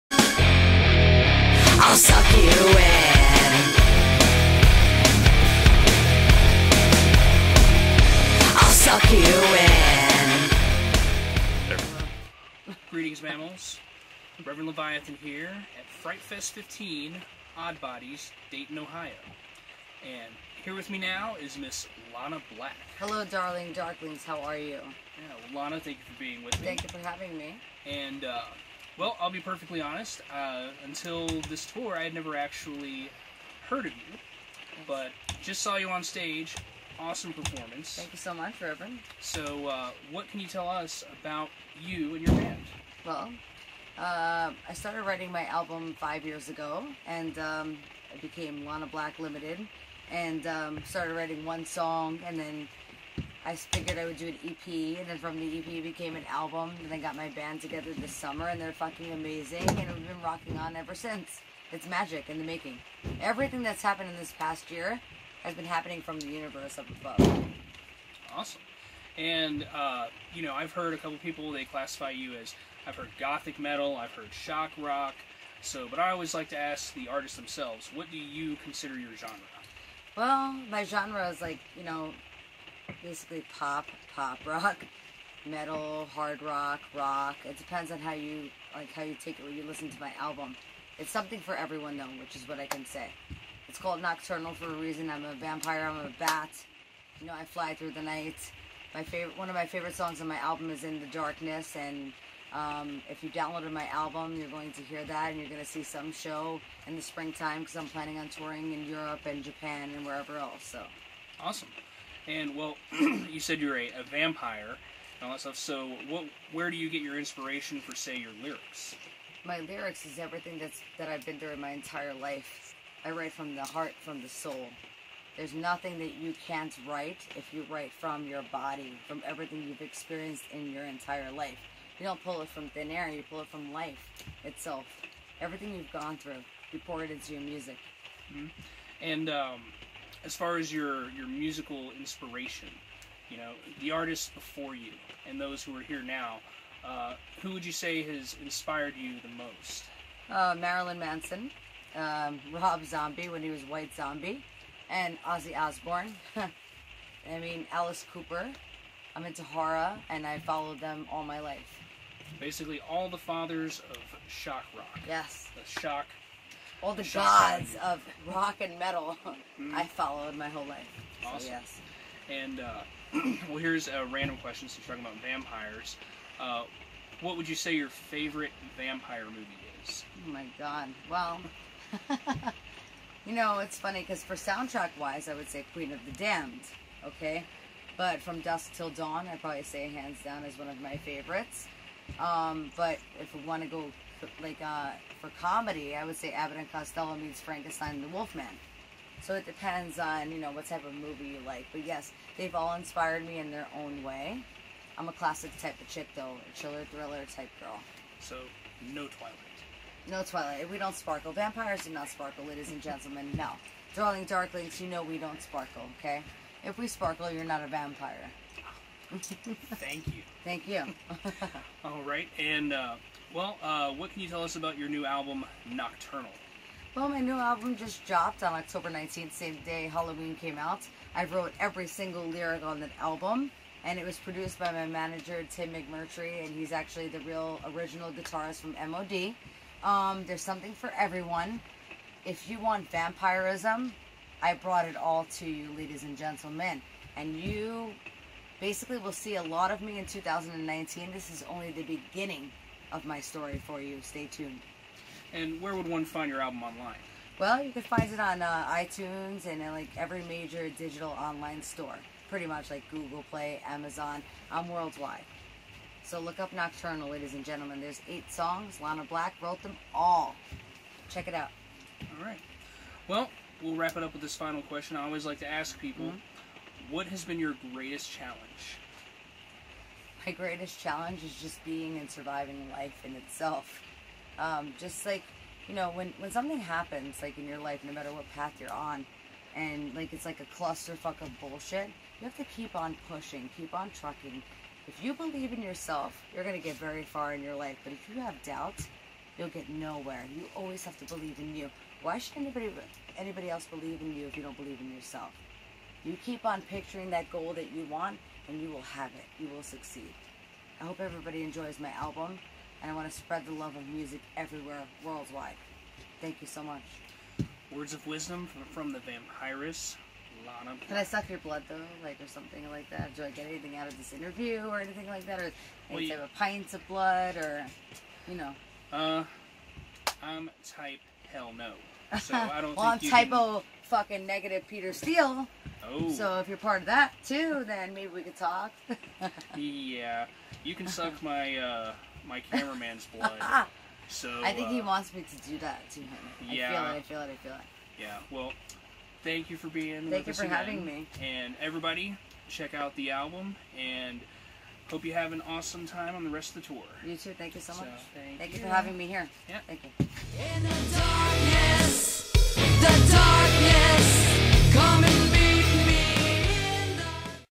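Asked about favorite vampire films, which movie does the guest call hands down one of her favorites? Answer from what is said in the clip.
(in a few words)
From Dusk Till Dawn.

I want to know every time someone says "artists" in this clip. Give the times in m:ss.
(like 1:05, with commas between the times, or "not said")
1:17, 2:23.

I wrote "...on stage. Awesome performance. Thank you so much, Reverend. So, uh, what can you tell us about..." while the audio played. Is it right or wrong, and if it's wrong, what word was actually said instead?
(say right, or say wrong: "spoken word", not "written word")
right.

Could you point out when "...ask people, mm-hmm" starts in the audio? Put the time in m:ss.
4:35.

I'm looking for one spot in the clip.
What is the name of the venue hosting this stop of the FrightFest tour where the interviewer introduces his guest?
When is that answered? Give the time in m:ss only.
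0:17.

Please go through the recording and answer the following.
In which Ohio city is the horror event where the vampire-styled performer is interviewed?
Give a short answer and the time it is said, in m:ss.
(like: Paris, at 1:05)
Dayton, at 0:18.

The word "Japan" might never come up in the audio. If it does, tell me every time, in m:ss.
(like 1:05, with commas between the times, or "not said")
1:49.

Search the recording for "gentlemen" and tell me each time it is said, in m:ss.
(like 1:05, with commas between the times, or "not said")
3:32, 4:06, 4:27.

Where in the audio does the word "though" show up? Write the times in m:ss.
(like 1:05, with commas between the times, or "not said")
1:31, 3:26, 5:21.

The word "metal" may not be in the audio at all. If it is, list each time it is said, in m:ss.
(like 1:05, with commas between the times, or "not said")
1:13, 1:25, 2:48.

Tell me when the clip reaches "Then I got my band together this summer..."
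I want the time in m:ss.
0:56.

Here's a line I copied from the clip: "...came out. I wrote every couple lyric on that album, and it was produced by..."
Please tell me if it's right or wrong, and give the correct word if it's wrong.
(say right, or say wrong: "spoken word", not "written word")
wrong: "single", not "couple".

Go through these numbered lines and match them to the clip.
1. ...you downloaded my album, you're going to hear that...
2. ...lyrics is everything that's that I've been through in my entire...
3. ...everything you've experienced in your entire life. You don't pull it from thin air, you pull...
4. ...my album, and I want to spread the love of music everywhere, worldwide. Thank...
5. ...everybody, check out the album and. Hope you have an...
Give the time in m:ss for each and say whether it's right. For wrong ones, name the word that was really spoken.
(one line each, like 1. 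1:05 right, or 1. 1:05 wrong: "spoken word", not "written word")
1. 1:43 right
2. 1:59 right
3. 2:09 right
4. 5:11 right
5. 5:51 right.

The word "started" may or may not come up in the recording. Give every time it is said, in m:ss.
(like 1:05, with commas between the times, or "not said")
0:44, 0:50.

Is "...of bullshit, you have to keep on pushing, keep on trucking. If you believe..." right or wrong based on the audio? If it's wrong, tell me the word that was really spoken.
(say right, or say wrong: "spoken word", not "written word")
right.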